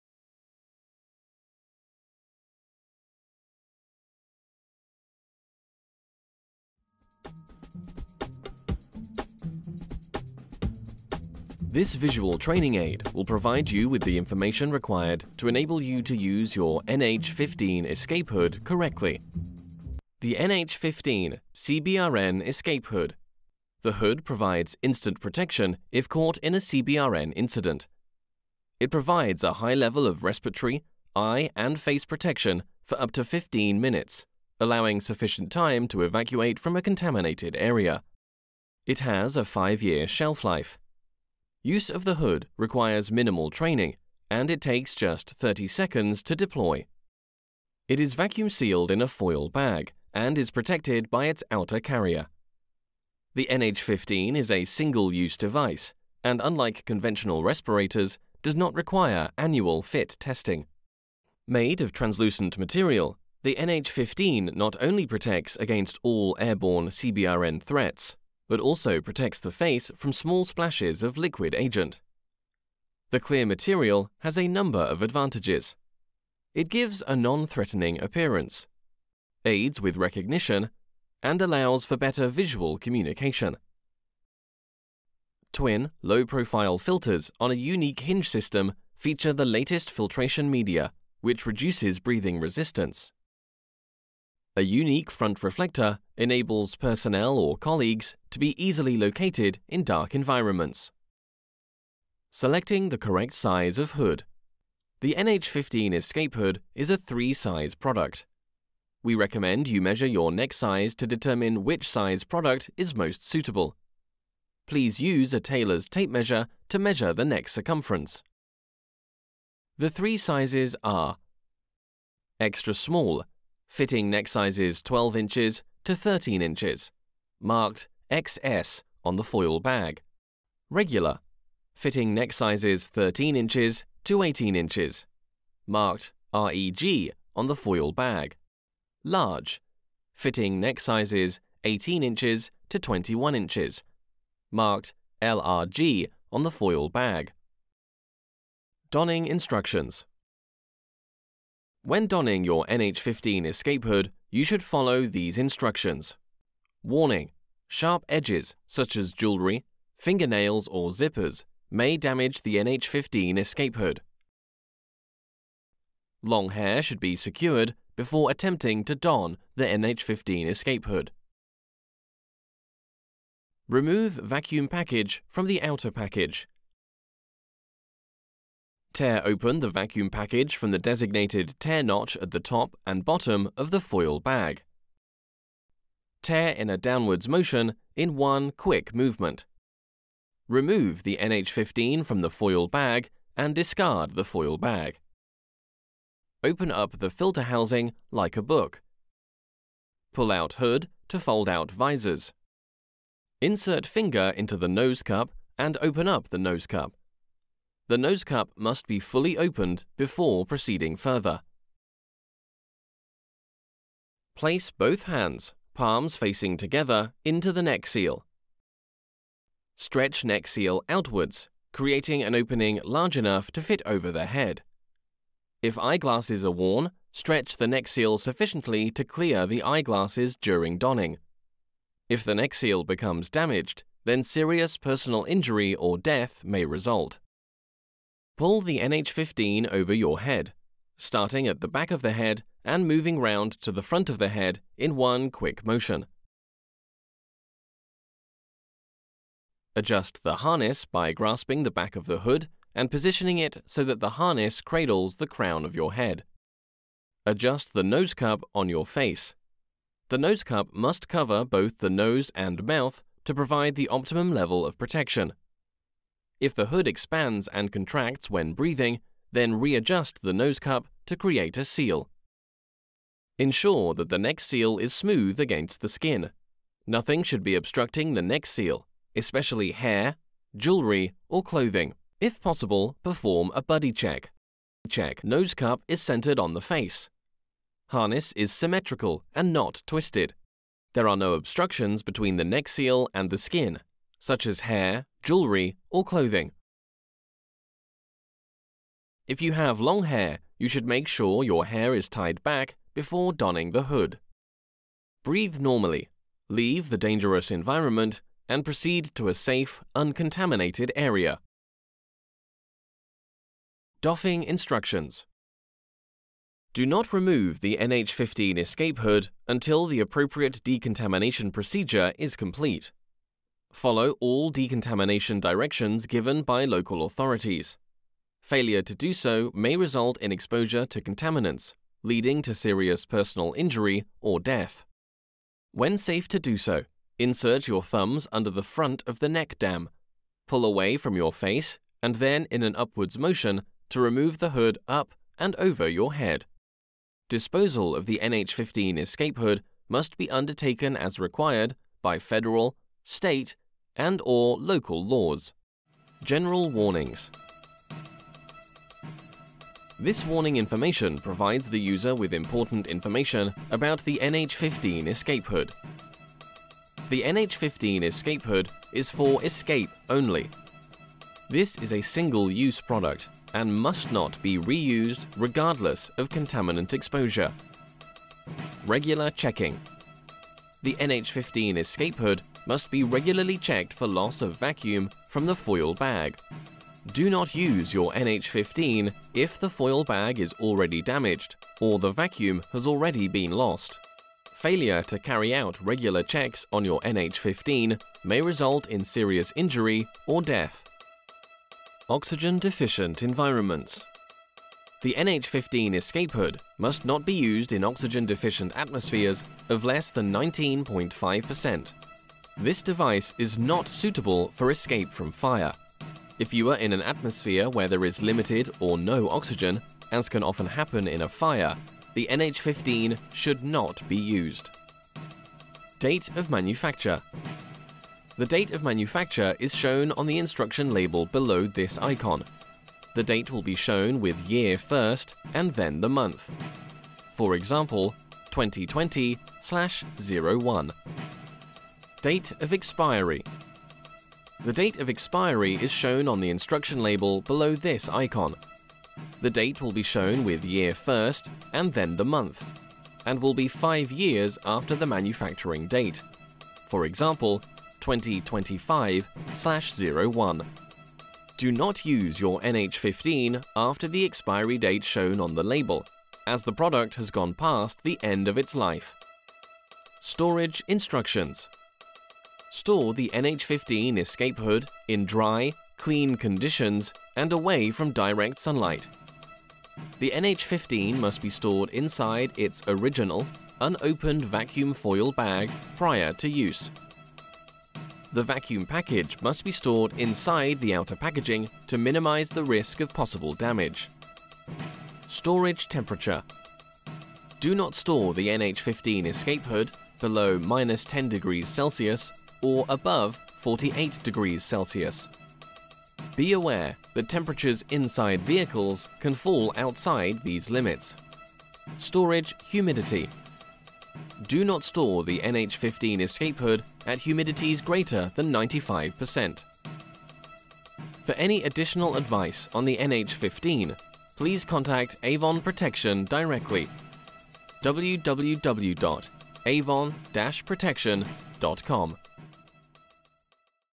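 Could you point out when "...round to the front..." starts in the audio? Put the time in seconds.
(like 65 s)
243 s.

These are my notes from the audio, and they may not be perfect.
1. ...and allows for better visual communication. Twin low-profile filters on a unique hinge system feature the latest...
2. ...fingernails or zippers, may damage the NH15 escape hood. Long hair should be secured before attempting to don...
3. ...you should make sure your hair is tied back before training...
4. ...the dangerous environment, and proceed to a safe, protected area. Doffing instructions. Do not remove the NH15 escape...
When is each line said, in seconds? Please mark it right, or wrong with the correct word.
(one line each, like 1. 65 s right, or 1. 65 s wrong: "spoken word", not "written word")
1. 81 s right
2. 159 s right
3. 300 s wrong: "donning", not "training"
4. 306 s wrong: "uncontaminated", not "protected".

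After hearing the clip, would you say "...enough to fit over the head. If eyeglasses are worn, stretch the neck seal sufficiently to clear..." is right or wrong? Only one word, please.
right.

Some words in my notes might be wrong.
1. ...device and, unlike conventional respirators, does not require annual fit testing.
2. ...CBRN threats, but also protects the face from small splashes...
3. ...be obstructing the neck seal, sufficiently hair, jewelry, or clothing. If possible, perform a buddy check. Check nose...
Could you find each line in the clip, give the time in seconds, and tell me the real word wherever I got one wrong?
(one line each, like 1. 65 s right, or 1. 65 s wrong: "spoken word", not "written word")
1. 55 s right
2. 66 s right
3. 277 s wrong: "especially", not "sufficiently".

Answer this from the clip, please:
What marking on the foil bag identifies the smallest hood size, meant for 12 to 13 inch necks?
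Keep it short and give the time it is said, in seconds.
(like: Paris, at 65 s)
XS, at 128 s.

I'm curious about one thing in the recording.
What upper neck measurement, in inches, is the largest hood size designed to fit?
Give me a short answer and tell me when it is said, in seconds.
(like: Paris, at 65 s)
21 inches, at 142 s.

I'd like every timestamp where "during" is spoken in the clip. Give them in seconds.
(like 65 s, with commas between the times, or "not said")
230 s.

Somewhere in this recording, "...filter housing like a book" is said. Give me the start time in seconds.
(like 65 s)
197 s.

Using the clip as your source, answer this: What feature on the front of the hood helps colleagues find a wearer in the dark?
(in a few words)
front reflector.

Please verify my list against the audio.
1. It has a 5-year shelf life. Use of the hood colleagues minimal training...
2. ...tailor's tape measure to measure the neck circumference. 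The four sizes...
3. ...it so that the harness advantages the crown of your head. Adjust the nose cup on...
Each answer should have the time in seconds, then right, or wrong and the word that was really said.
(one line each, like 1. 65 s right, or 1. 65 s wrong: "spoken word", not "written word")
1. 38 s wrong: "requires", not "colleagues"
2. 115 s wrong: "three", not "four"
3. 253 s wrong: "cradles", not "advantages".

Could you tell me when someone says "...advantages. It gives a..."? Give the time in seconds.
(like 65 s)
75 s.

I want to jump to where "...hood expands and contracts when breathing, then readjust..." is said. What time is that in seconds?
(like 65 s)
266 s.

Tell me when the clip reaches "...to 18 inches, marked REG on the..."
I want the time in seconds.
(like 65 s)
134 s.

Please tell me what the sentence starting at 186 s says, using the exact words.
Tear in a downwards motion in one quick movement.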